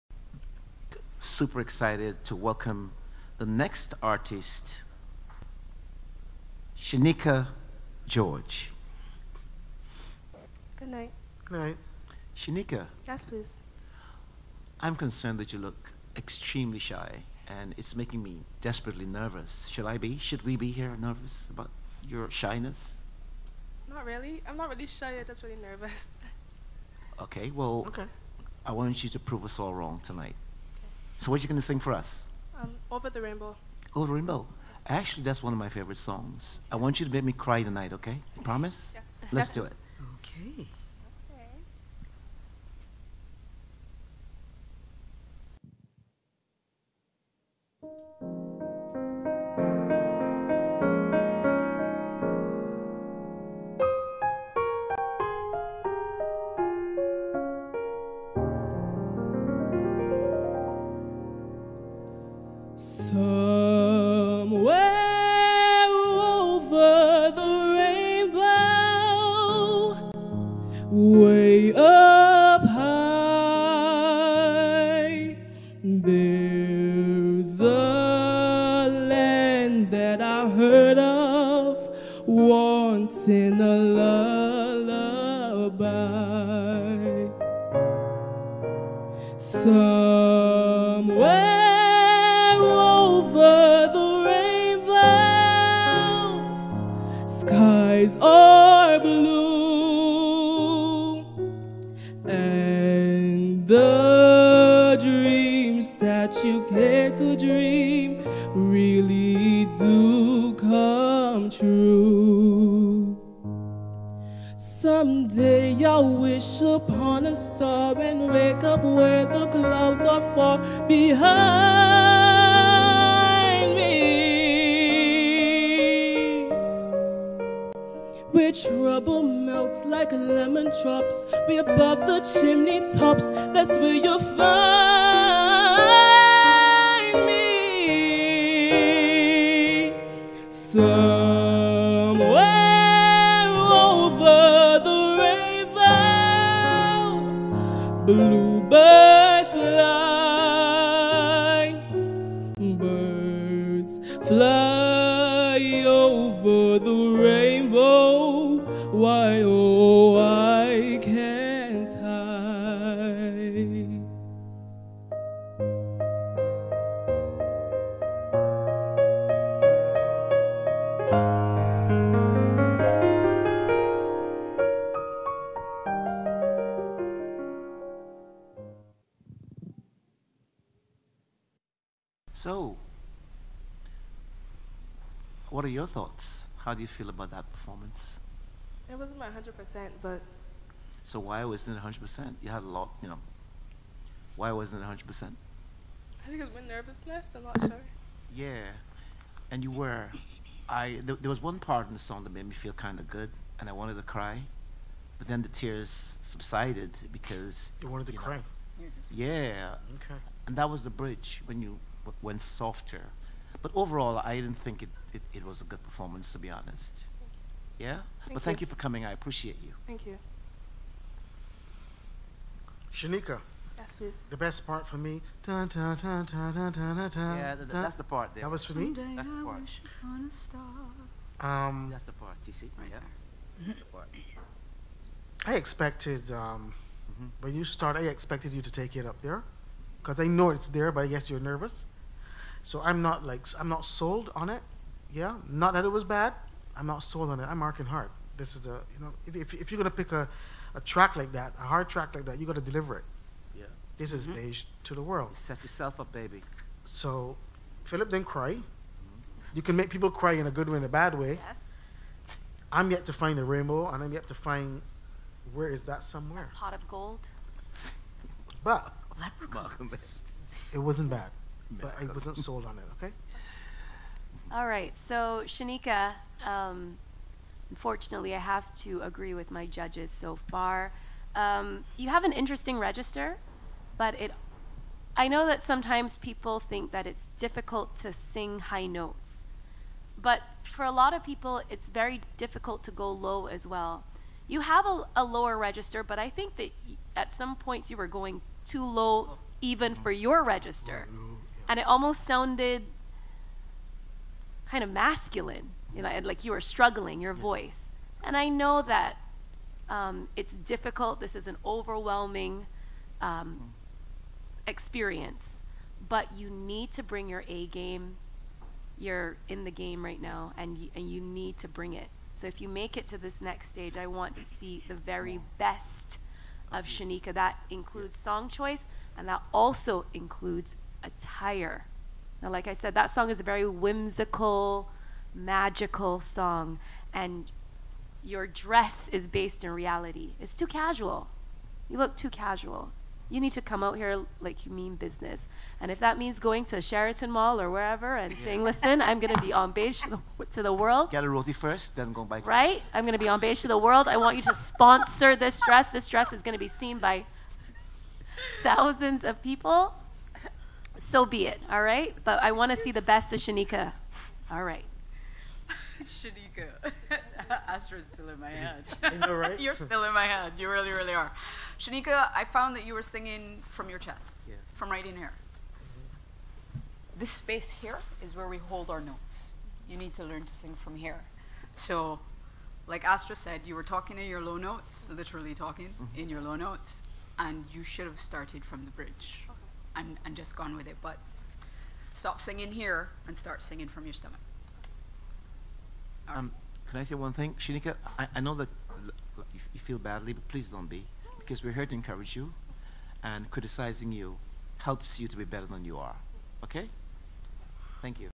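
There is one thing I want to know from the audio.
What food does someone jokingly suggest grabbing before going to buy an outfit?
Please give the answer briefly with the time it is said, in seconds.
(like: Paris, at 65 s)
Roti, at 351 s.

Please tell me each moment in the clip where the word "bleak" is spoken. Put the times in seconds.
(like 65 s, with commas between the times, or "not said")
not said.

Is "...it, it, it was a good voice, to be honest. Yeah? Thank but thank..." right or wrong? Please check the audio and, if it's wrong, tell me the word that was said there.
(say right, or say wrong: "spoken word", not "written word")
wrong: "performance", not "voice".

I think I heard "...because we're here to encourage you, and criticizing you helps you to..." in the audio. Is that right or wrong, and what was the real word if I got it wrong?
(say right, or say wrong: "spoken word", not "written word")
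right.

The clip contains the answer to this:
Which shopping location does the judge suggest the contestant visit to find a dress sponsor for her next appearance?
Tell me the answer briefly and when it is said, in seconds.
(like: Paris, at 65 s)
Sheraton Mall, at 346 s.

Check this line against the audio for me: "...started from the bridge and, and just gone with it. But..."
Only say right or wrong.
right.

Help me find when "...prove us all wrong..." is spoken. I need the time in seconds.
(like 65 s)
29 s.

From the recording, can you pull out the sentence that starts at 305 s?
You know, like you were struggling, your voice.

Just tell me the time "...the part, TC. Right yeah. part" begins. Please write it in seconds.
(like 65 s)
232 s.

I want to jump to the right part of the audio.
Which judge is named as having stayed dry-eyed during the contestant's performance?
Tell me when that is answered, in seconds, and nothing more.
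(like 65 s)
257 s.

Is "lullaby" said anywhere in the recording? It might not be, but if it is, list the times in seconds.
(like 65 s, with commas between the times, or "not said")
83 s.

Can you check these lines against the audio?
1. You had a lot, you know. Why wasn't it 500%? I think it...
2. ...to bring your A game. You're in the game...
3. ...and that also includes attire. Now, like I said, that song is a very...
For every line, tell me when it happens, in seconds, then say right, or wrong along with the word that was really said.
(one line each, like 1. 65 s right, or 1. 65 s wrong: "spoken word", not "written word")
1. 192 s wrong: "100", not "500"
2. 316 s right
3. 329 s right.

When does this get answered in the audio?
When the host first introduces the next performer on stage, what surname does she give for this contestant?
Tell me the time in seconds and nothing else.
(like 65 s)
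8 s.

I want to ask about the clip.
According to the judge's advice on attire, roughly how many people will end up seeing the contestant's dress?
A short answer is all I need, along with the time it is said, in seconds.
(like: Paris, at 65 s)
Thousands, at 358 s.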